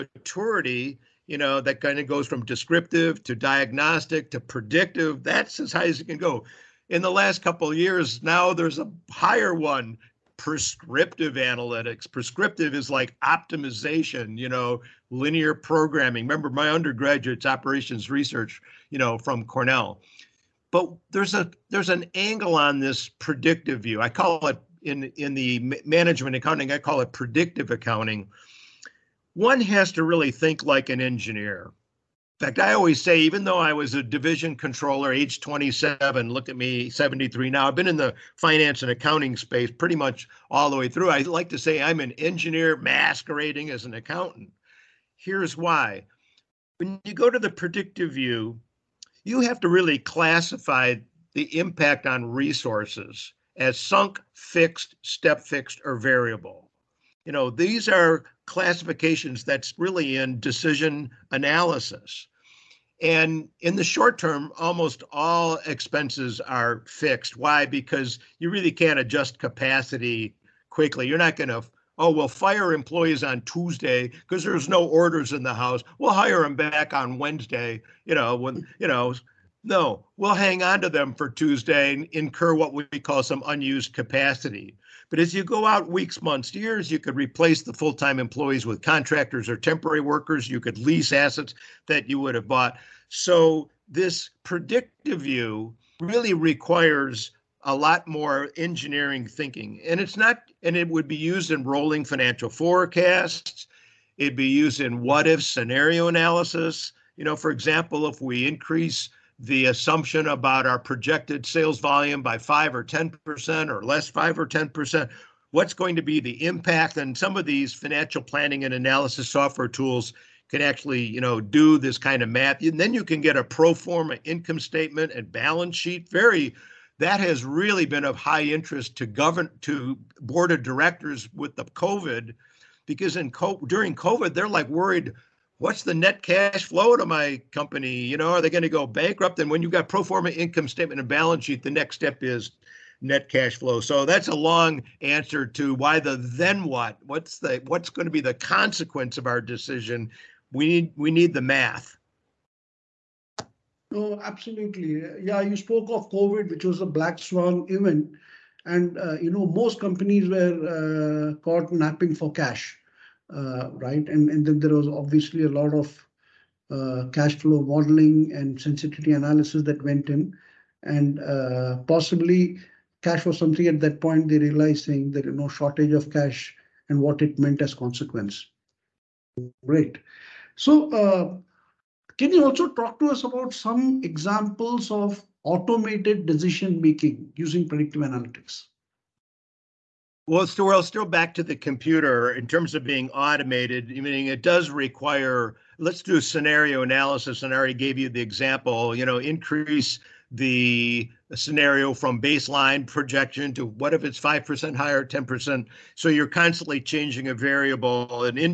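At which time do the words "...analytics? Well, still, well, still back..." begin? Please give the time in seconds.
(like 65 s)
188 s.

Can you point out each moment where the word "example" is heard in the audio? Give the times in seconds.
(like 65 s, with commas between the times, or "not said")
107 s, 184 s, 198 s.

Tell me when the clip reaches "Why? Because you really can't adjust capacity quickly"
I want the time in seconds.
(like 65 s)
67 s.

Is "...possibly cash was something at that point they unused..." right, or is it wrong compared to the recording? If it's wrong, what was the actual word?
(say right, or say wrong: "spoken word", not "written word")
wrong: "realized", not "unused".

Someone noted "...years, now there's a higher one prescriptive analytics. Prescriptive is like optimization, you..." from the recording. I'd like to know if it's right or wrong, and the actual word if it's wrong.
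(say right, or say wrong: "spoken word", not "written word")
right.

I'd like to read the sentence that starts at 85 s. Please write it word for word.
But as you go out weeks, months, years, you could replace the full time employees with contractors or temporary workers.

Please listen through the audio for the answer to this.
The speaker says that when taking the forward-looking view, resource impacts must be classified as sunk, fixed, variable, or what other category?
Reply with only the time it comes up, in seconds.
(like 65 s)
55 s.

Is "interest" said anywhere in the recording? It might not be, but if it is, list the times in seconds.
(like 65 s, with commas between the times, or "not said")
128 s.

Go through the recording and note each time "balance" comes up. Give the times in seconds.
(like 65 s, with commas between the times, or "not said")
125 s, 141 s.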